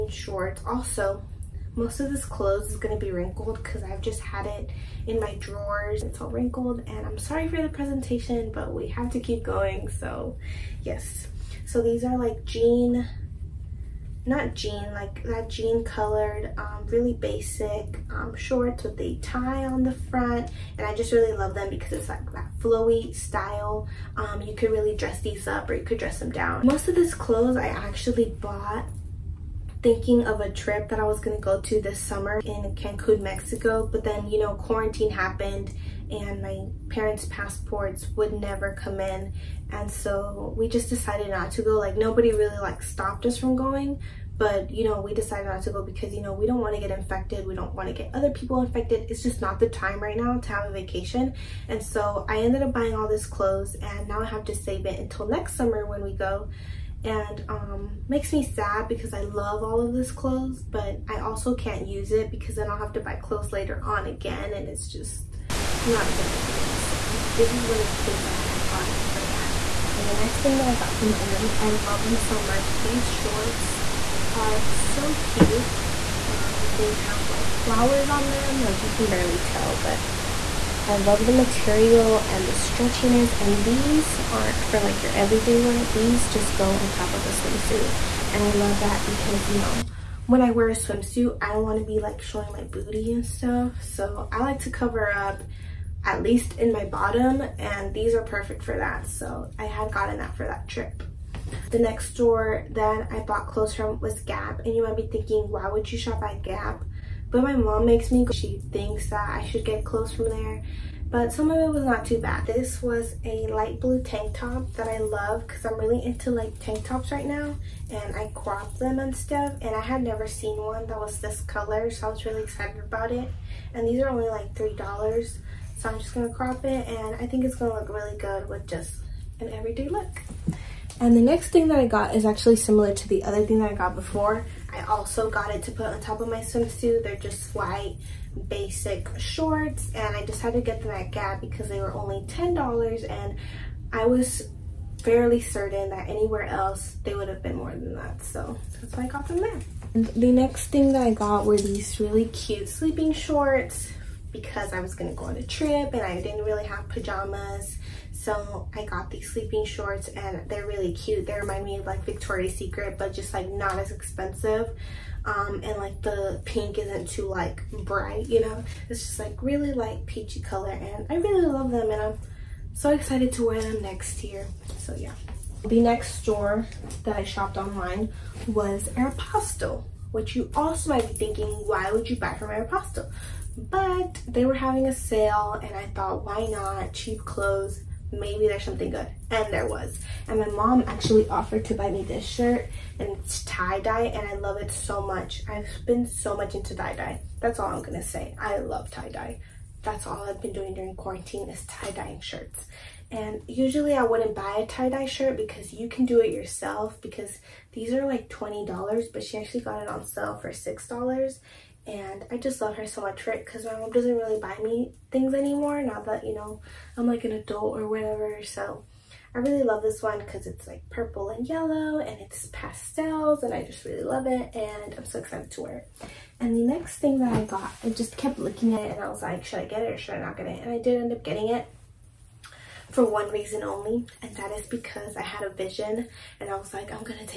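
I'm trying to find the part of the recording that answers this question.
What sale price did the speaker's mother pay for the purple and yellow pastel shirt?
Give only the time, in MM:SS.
03:30.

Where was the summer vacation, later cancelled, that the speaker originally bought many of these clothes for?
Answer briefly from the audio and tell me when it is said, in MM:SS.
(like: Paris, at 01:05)
Cancun, Mexico, at 00:32.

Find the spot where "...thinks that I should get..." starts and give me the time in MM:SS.
01:48.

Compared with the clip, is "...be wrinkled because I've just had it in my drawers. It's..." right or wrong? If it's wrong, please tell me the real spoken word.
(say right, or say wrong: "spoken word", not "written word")
right.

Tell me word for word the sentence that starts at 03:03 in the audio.
but they were having a sale and I thought, why not?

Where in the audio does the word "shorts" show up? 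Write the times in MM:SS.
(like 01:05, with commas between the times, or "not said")
00:00, 00:18, 01:13, 02:19, 02:33, 02:39.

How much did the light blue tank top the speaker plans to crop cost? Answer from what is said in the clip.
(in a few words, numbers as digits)
$3.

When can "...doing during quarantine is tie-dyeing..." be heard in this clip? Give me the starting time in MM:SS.
03:20.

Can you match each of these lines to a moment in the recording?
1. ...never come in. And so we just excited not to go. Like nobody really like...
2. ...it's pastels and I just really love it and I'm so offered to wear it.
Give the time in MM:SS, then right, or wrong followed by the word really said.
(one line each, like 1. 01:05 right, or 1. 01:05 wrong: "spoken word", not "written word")
1. 00:38 wrong: "decided", not "excited"
2. 03:42 wrong: "excited", not "offered".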